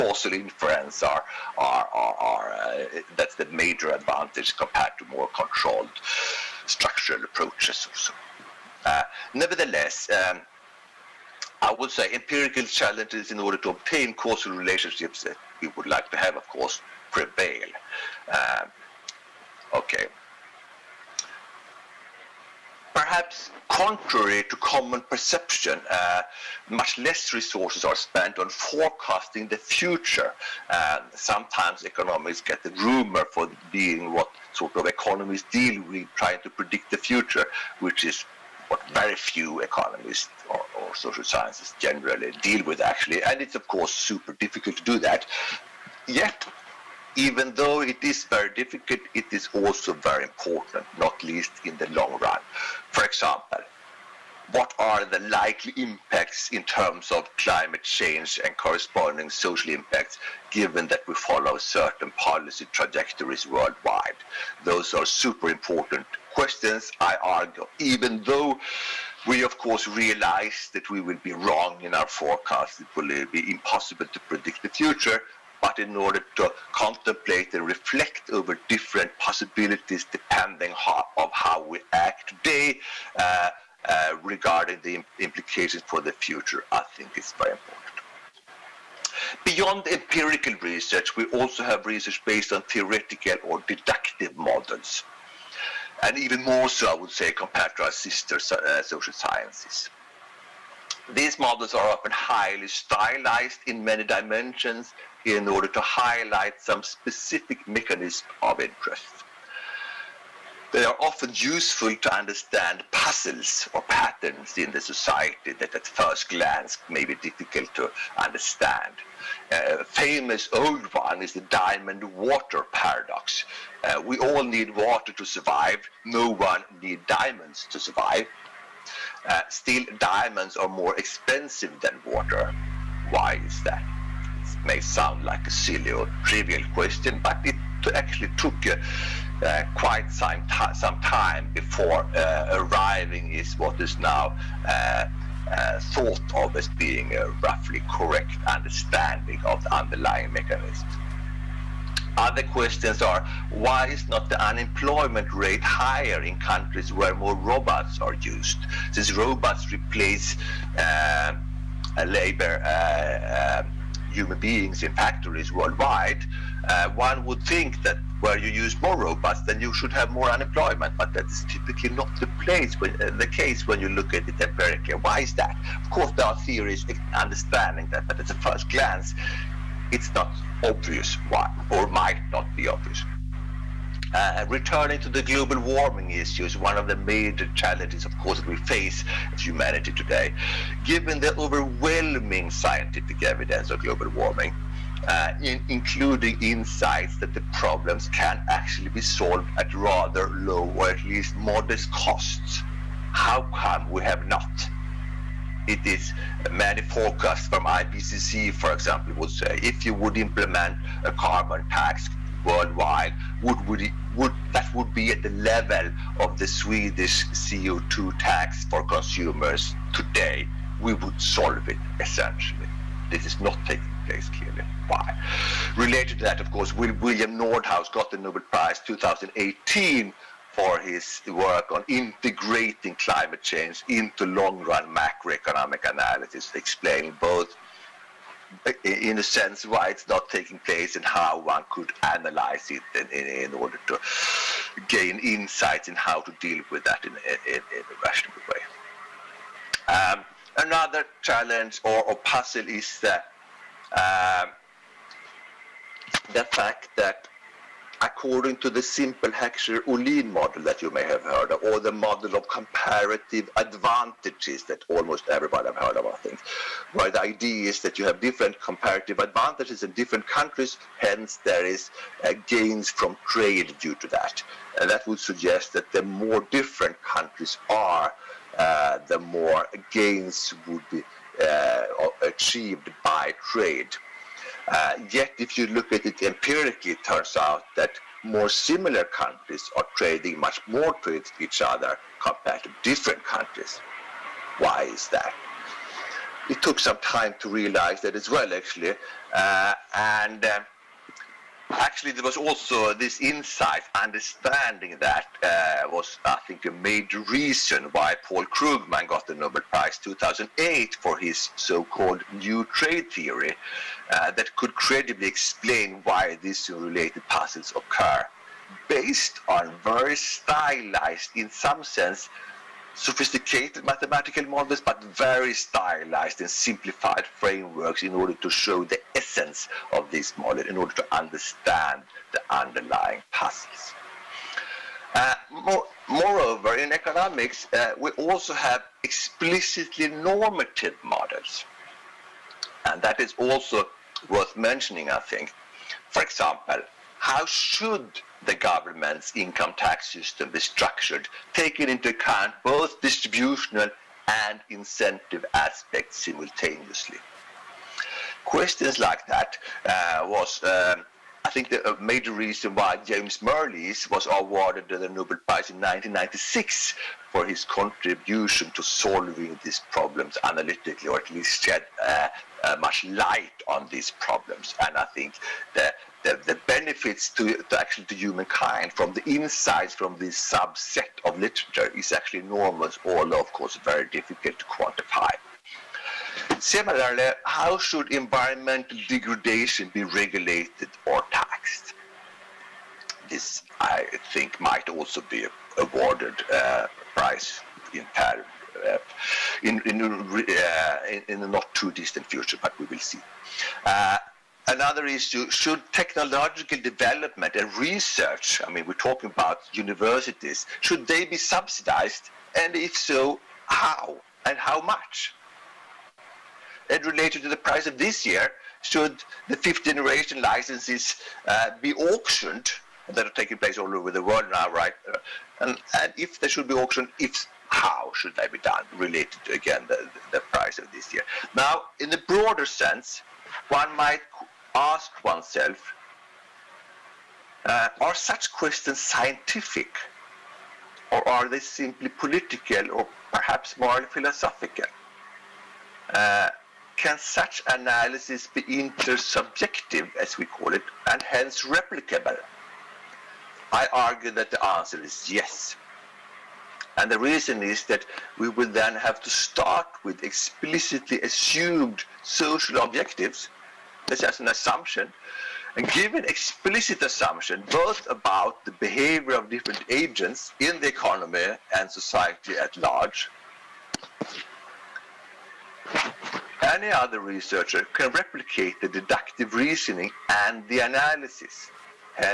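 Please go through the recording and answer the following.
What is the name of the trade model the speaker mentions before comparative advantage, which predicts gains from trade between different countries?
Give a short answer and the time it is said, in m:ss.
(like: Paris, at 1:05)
Heckscher-Ohlin model, at 4:19.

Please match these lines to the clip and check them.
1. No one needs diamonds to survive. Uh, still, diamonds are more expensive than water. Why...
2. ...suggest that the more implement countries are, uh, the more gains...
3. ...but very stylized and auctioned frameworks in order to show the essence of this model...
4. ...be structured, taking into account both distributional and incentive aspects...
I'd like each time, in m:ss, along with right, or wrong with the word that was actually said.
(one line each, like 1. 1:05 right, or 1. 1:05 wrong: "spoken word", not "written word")
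1. 2:06 right
2. 4:35 wrong: "different", not "implement"
3. 5:24 wrong: "simplified", not "auctioned"
4. 5:50 right.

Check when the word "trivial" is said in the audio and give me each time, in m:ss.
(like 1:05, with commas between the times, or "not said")
2:16.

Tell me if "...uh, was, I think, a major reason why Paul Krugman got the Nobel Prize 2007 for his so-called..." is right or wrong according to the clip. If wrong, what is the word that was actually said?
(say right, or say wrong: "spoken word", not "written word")
wrong: "2008", not "2007".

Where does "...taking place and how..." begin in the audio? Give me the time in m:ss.
4:00.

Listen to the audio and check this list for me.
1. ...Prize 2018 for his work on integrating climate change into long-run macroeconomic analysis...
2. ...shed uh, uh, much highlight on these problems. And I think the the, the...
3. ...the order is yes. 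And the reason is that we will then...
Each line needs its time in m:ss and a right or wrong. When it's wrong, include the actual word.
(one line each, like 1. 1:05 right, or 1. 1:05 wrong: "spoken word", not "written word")
1. 3:48 right
2. 6:11 wrong: "light", not "highlight"
3. 7:34 wrong: "answer", not "order".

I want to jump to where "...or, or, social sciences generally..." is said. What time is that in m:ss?
0:40.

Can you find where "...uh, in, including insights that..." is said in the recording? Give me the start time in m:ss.
3:15.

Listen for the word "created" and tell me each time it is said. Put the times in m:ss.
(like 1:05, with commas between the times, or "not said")
not said.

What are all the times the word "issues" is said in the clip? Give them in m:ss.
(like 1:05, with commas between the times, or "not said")
3:06, 6:45.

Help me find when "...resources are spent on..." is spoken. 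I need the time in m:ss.
0:27.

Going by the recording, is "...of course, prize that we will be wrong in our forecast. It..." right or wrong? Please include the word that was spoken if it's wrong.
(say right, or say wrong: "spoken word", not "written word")
wrong: "realize", not "prize".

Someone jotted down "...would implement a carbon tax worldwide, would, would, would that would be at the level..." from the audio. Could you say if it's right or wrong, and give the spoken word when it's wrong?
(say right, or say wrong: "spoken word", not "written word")
right.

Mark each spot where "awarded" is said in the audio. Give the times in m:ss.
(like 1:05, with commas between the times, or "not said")
6:04, 6:35.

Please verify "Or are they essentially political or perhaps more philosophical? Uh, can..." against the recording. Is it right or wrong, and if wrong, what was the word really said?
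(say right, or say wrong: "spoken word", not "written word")
wrong: "simply", not "essentially".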